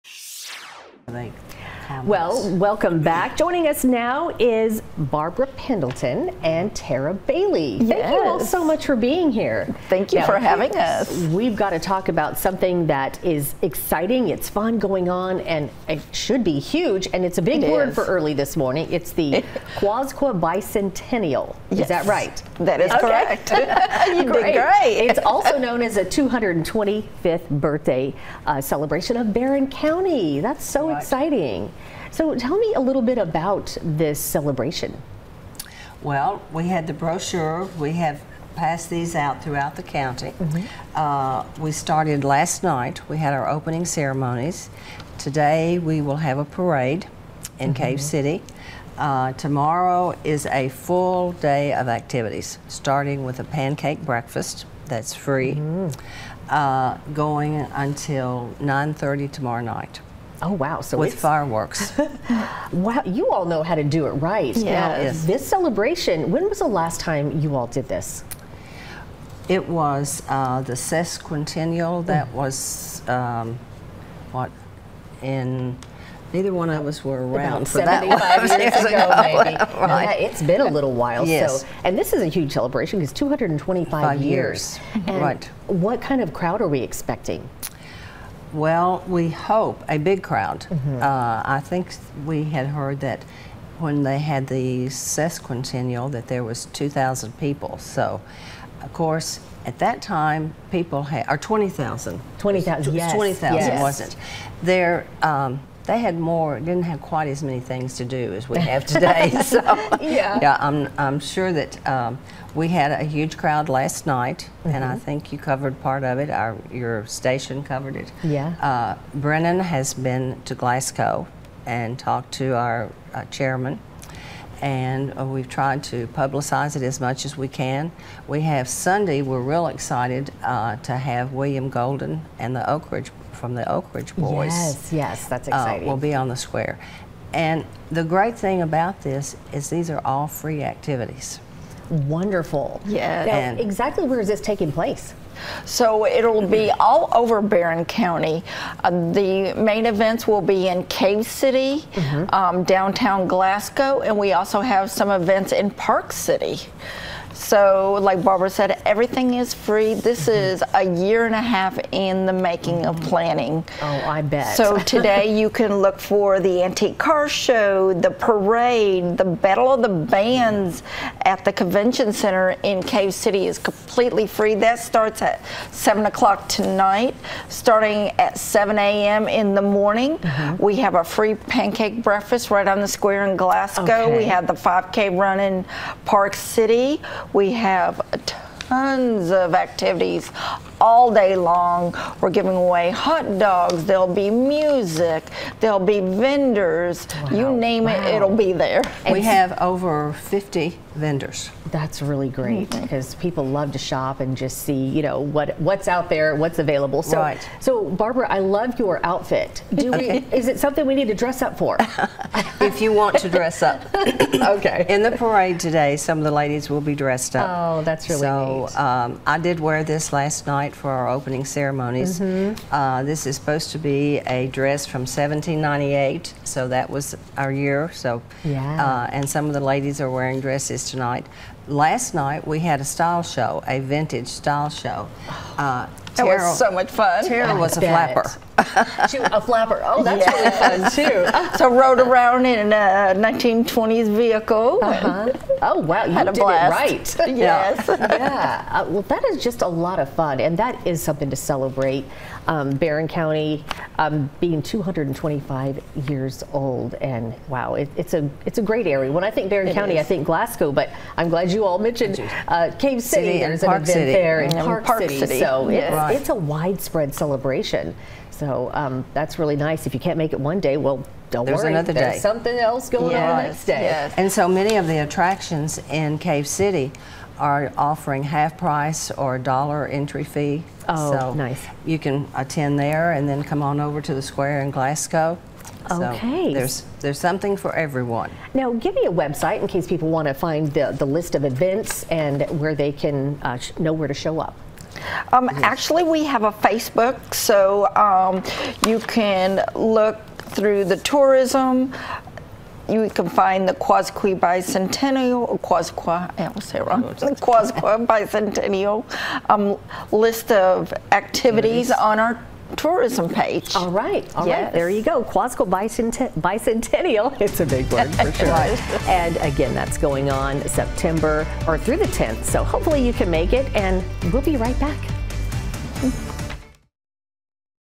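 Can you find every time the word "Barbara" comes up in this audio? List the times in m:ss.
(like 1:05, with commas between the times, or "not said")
0:04, 2:38, 3:28.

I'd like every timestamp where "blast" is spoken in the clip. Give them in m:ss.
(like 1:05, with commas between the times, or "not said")
4:06.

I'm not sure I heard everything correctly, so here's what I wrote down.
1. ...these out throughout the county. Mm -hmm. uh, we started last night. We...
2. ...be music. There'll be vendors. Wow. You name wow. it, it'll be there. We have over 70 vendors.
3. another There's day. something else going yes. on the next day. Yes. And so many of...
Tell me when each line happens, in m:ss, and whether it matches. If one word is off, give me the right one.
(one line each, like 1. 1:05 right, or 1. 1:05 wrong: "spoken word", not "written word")
1. 0:38 right
2. 3:14 wrong: "50", not "70"
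3. 4:31 right.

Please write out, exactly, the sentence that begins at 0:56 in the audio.
uh, going until 9:30 tomorrow night.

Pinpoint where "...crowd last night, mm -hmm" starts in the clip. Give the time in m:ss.
1:53.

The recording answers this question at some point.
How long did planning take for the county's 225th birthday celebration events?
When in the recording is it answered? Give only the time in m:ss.
2:40.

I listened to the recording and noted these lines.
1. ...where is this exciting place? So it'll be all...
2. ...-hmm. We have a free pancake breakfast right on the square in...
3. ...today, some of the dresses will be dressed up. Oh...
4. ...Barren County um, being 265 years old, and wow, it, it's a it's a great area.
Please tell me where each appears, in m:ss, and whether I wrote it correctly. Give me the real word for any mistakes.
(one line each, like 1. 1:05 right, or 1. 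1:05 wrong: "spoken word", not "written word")
1. 2:24 wrong: "taking", not "exciting"
2. 3:00 right
3. 3:35 wrong: "ladies", not "dresses"
4. 4:12 wrong: "225", not "265".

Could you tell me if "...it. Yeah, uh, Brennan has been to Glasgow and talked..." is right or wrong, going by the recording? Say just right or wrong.
right.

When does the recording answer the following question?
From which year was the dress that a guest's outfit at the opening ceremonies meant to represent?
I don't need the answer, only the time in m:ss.
3:45.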